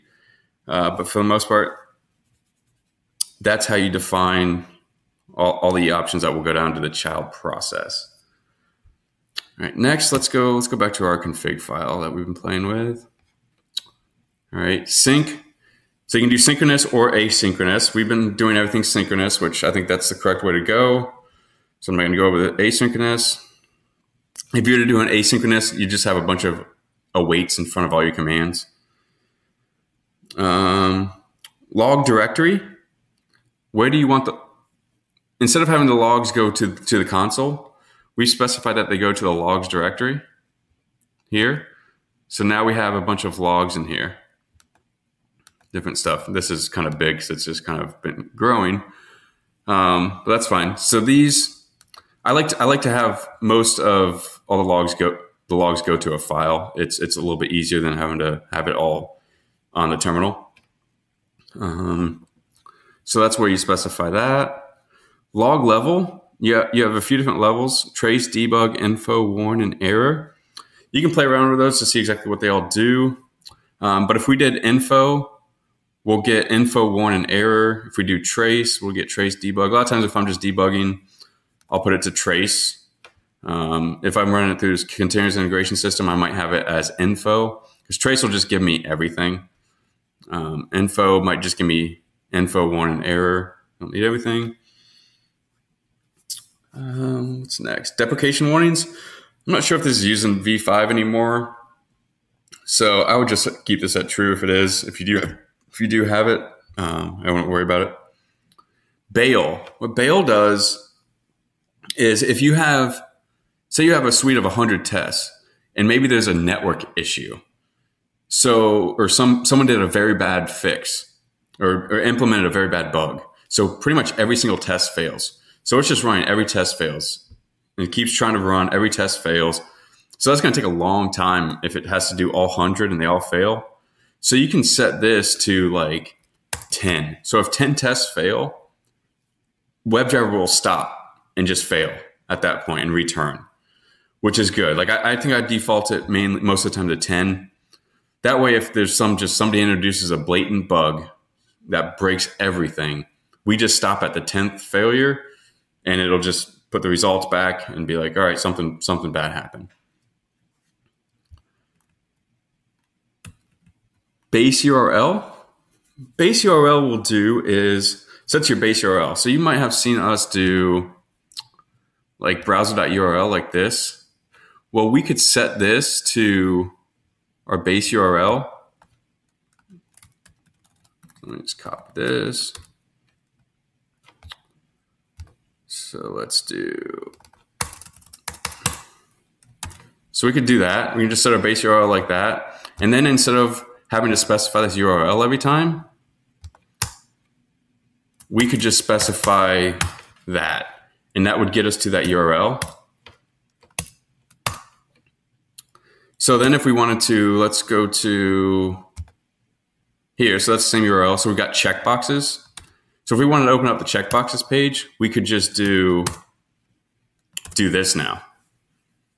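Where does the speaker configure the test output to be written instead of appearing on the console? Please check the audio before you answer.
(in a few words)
logs directory.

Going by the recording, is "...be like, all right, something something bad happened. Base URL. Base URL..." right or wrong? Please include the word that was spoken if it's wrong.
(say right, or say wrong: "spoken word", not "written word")
right.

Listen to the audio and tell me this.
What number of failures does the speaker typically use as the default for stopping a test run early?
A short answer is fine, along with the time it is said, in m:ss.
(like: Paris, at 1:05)
10, at 2:25.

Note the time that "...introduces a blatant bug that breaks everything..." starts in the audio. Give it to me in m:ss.
2:29.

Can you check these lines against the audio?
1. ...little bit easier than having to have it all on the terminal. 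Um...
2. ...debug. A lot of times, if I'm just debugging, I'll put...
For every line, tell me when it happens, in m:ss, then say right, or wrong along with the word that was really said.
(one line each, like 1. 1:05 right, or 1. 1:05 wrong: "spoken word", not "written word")
1. 0:57 right
2. 1:19 right.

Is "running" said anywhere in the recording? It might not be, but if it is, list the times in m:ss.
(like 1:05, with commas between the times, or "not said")
1:24, 2:06.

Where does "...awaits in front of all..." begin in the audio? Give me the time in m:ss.
0:27.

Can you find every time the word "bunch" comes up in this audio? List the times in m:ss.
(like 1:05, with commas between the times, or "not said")
0:26, 0:42.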